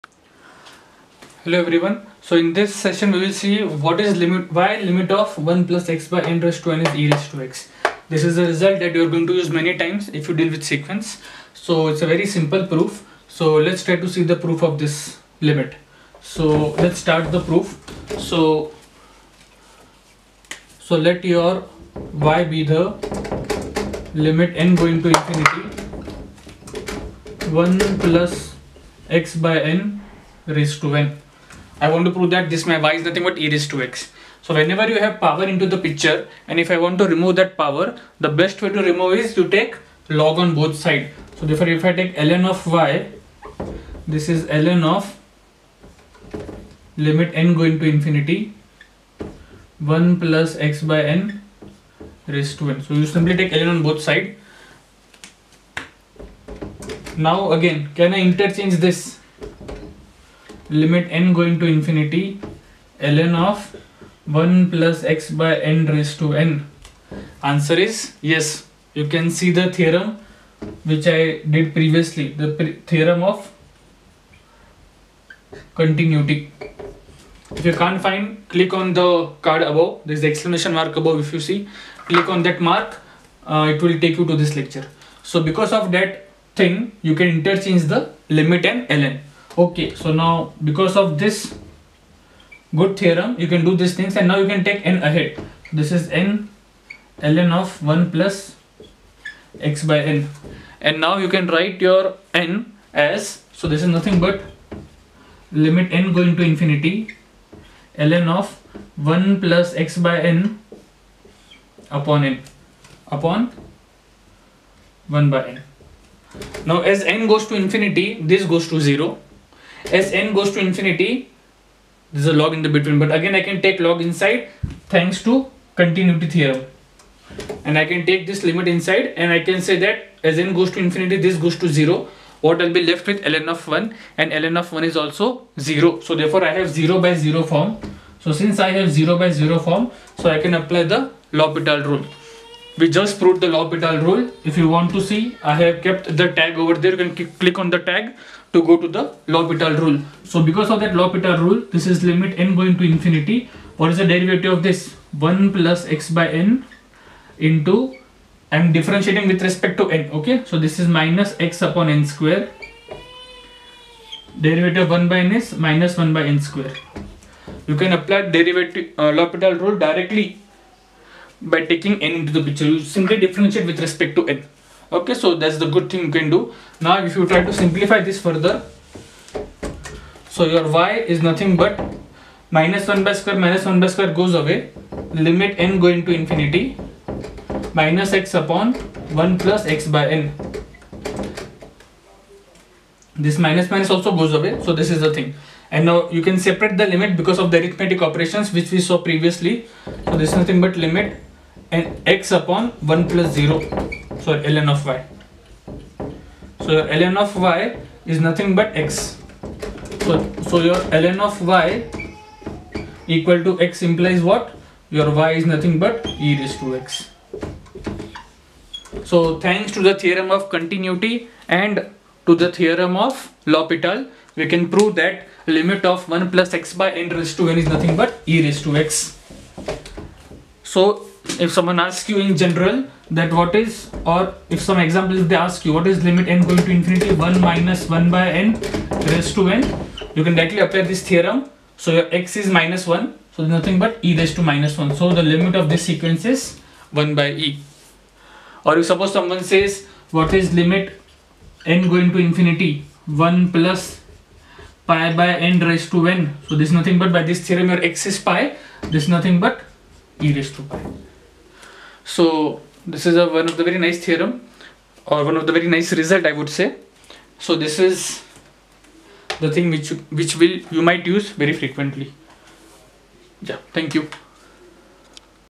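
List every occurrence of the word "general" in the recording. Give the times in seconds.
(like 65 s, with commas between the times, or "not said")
232 s.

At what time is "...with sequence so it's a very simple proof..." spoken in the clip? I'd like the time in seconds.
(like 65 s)
10 s.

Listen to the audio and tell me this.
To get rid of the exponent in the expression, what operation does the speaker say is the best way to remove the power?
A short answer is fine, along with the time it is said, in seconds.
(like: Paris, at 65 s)
take log on both side, at 39 s.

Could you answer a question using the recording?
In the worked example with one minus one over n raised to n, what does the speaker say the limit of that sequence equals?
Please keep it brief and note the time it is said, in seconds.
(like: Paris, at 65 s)
1 by e, at 247 s.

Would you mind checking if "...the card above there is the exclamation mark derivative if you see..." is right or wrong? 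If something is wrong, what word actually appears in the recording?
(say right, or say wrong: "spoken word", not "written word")
wrong: "above", not "derivative".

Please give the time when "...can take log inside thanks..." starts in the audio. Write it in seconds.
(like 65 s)
123 s.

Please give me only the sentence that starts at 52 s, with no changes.
So you simply take ln on both side.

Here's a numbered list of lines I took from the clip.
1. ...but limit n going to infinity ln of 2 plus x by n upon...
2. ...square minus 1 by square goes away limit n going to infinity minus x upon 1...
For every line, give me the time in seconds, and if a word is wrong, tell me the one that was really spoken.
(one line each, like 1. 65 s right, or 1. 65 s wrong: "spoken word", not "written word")
1. 104 s wrong: "1", not "2"
2. 183 s right.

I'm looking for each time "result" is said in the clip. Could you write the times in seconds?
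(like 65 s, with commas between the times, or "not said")
8 s, 266 s.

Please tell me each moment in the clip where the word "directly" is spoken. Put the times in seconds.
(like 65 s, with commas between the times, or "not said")
169 s, 240 s.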